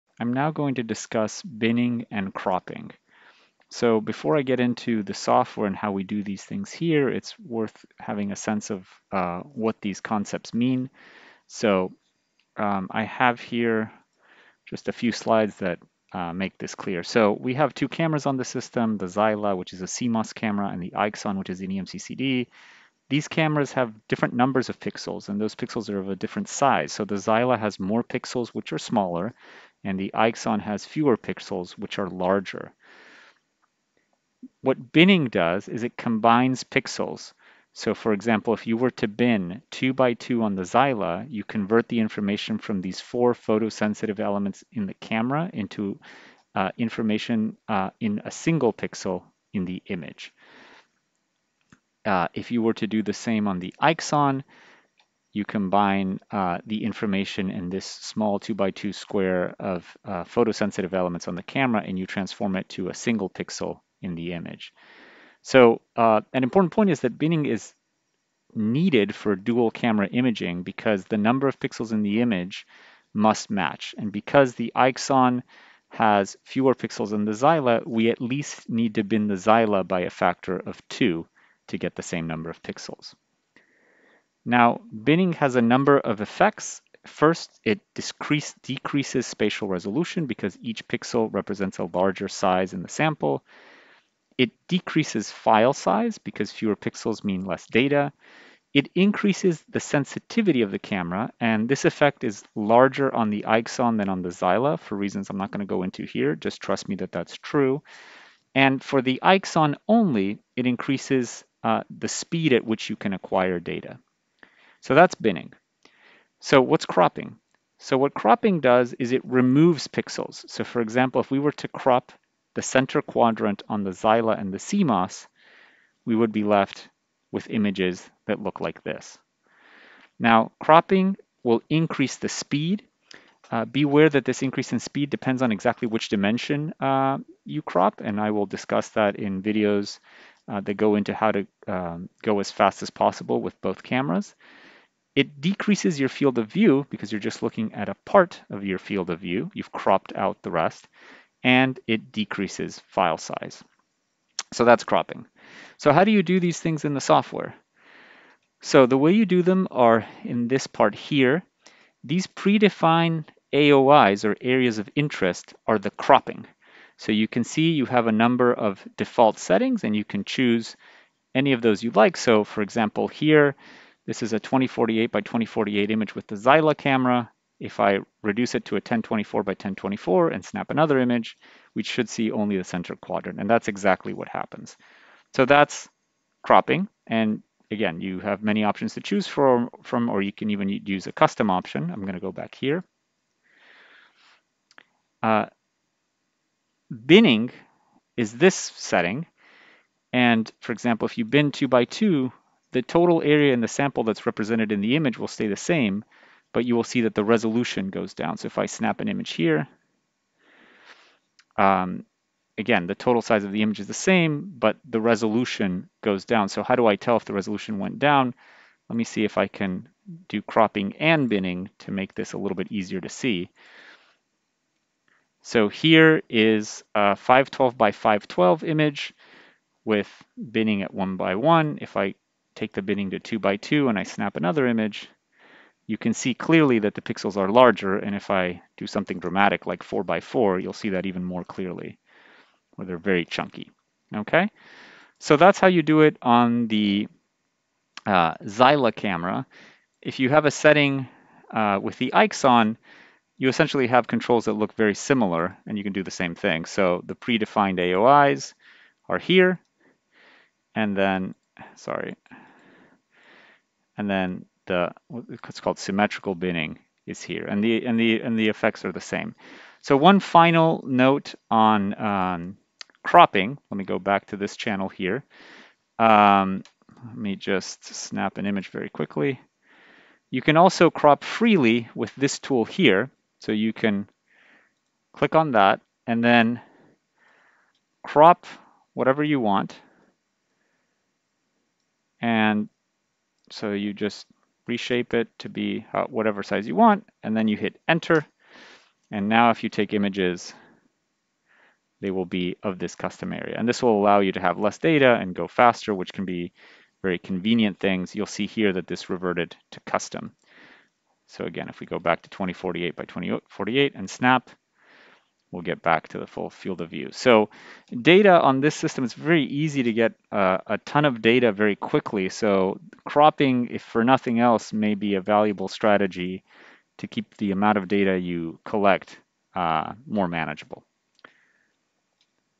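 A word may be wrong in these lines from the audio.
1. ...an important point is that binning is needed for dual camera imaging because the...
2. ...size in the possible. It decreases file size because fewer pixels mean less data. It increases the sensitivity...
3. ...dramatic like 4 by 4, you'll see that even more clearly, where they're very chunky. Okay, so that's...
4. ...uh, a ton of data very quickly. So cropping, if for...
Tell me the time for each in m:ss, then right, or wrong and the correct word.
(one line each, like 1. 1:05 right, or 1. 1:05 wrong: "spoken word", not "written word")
1. 1:06 right
2. 1:32 wrong: "sample", not "possible"
3. 3:59 right
4. 5:20 right.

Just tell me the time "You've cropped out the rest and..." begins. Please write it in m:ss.
2:29.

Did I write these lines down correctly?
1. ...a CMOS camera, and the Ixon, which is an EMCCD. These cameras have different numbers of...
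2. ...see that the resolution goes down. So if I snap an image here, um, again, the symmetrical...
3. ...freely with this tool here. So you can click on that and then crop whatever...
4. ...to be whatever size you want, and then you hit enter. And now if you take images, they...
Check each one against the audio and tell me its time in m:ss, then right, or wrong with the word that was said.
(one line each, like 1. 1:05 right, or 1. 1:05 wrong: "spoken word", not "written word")
1. 0:19 right
2. 3:26 wrong: "total", not "symmetrical"
3. 4:41 right
4. 4:55 right.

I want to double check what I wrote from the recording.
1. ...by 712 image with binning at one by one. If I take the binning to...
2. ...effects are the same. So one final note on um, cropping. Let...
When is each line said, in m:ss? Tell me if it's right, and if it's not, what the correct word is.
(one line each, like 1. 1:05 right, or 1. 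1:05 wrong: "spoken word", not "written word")
1. 3:47 wrong: "512", not "712"
2. 4:28 right.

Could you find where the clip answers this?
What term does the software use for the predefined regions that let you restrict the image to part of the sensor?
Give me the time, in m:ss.
2:44.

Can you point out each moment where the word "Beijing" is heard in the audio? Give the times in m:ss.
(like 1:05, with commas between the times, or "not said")
not said.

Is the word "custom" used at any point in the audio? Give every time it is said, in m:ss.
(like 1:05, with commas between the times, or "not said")
3:11, 5:02, 5:09.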